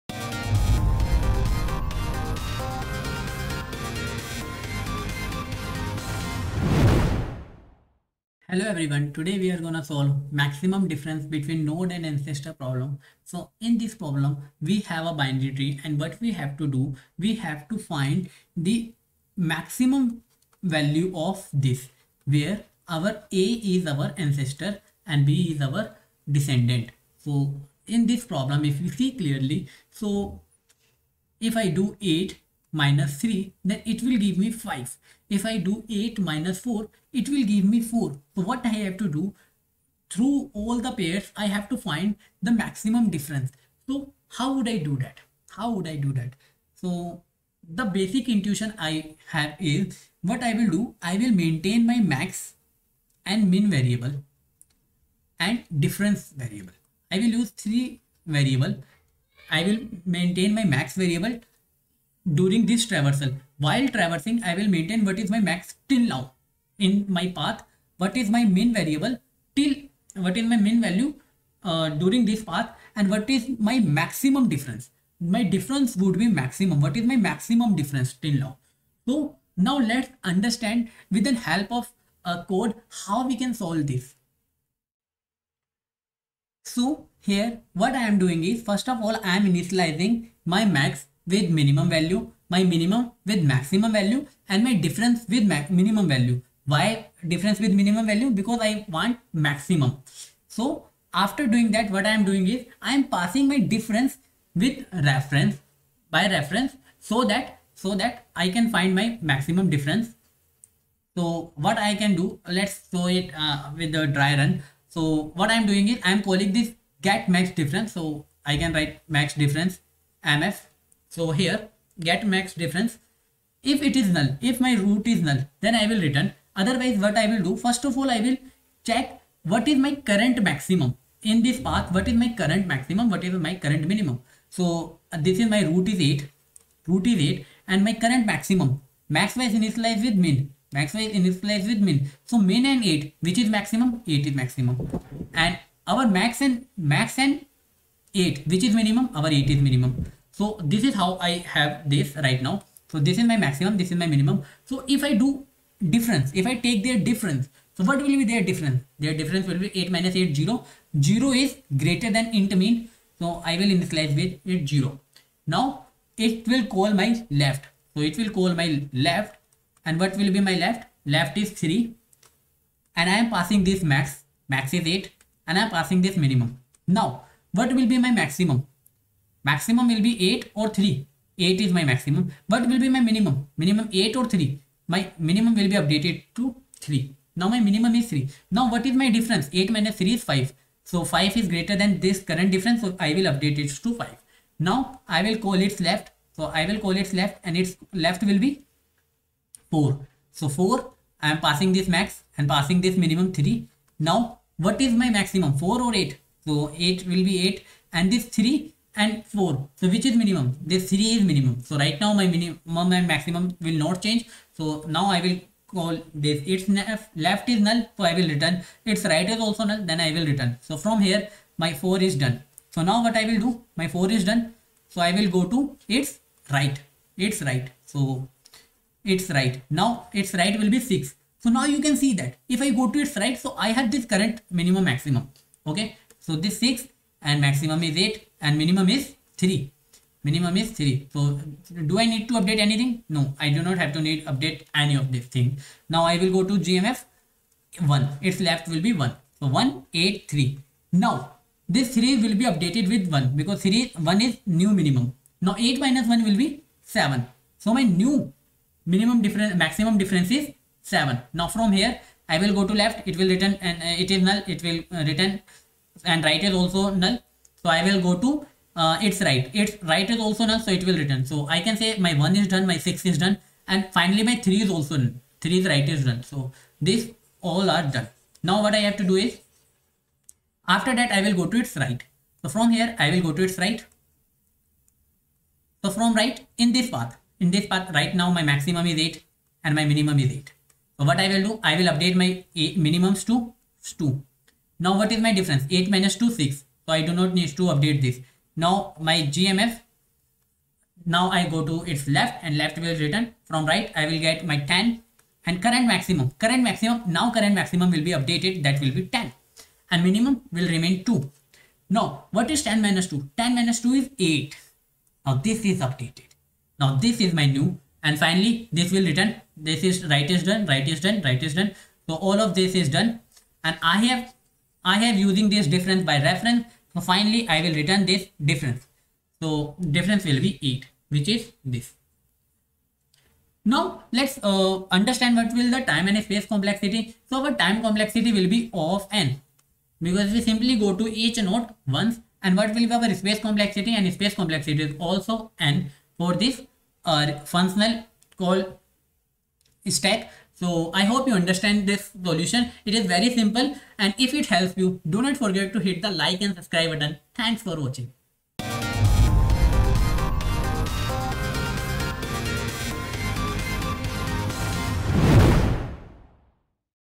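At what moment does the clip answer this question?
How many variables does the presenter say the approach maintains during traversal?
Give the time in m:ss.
0:57.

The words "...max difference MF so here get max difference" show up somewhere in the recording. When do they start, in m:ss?
1:59.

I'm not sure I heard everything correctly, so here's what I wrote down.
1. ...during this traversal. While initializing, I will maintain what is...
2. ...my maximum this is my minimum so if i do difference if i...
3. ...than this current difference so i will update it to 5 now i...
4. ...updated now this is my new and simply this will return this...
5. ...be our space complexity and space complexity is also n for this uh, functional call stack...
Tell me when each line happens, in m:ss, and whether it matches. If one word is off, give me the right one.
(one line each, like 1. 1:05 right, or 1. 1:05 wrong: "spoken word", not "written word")
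1. 1:02 wrong: "traversing", not "initializing"
2. 2:33 right
3. 3:11 right
4. 5:15 wrong: "finally", not "simply"
5. 5:42 right.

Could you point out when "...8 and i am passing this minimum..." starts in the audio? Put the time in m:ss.
2:54.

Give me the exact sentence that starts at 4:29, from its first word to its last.
It's right is also null, so it will return.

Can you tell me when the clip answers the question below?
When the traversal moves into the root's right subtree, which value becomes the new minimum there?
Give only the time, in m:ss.
4:51.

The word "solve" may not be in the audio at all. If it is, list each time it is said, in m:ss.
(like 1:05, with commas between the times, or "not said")
0:09, 1:23.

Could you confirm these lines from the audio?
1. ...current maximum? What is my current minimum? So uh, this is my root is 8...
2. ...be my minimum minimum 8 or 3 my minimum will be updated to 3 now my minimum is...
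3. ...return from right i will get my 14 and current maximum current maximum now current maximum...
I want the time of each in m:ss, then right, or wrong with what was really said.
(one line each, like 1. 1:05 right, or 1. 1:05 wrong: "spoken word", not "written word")
1. 2:12 right
2. 3:02 right
3. 5:03 wrong: "10", not "14".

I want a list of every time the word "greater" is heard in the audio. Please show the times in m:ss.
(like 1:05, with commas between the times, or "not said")
2:41, 3:11.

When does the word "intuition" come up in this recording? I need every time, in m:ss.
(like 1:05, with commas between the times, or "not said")
0:48.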